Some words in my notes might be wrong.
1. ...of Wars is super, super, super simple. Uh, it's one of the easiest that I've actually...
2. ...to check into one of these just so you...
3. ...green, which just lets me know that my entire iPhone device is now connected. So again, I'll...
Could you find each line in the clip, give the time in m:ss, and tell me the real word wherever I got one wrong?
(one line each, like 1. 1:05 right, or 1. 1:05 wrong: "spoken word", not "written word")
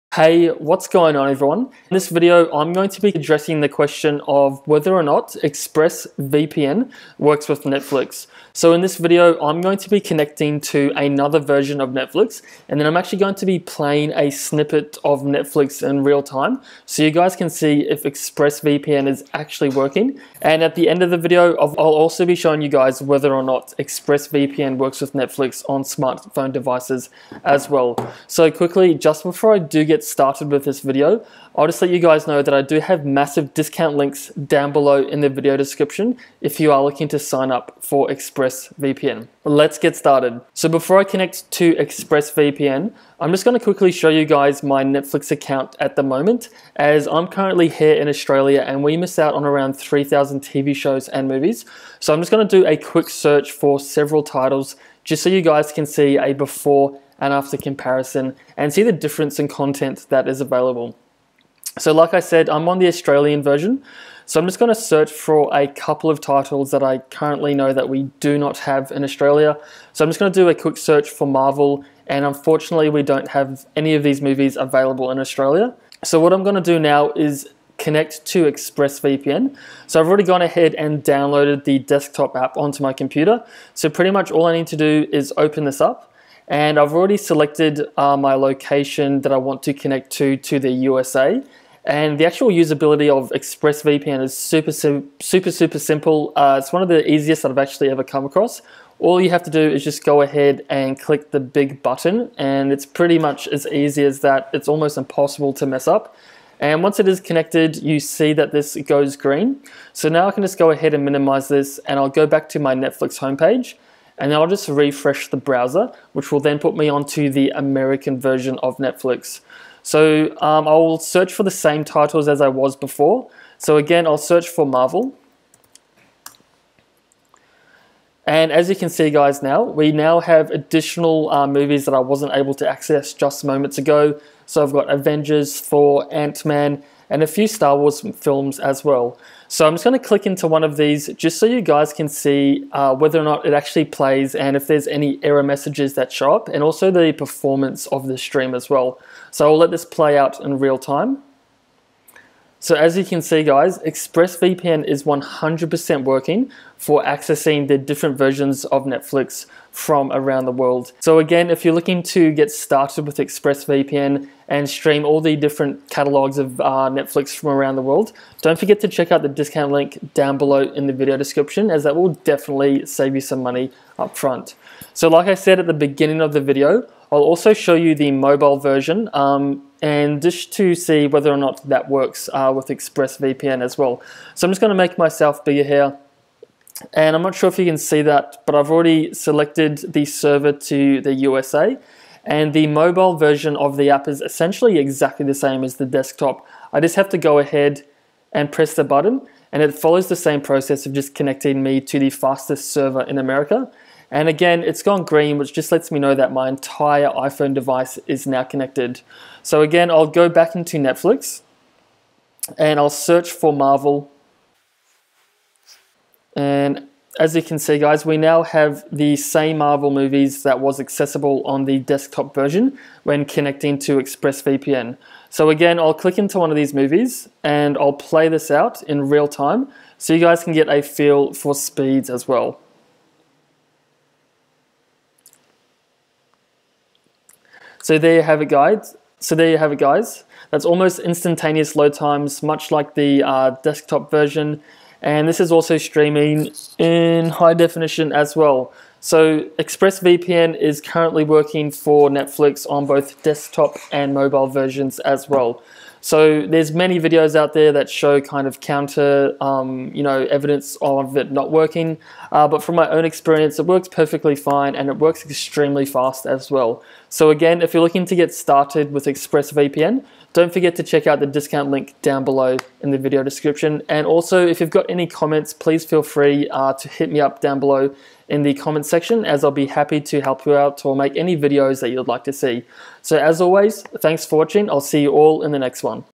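1. 1:33 wrong: "ExpressVPN", not "Wars"
2. 2:19 wrong: "click", not "check"
3. 3:25 right.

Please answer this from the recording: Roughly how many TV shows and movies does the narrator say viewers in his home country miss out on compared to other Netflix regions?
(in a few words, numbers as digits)
3,000.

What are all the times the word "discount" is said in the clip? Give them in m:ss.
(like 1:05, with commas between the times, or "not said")
0:33, 2:49, 4:31.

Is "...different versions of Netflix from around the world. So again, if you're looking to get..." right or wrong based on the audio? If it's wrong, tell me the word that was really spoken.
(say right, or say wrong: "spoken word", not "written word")
right.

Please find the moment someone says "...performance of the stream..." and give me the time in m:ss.
2:27.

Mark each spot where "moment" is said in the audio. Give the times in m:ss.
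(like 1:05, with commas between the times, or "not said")
0:46, 2:13.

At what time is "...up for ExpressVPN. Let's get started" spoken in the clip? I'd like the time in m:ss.
0:37.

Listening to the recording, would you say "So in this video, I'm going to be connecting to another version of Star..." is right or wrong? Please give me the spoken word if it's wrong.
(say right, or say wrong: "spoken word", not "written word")
wrong: "Netflix", not "Star".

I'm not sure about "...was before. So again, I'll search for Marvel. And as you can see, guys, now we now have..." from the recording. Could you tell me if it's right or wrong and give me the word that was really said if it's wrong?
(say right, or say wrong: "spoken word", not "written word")
right.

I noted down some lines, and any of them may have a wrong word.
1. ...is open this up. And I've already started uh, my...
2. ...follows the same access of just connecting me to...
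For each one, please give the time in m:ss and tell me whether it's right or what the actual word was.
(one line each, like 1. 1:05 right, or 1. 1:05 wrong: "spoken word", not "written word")
1. 1:25 wrong: "selected", not "started"
2. 3:19 wrong: "process", not "access".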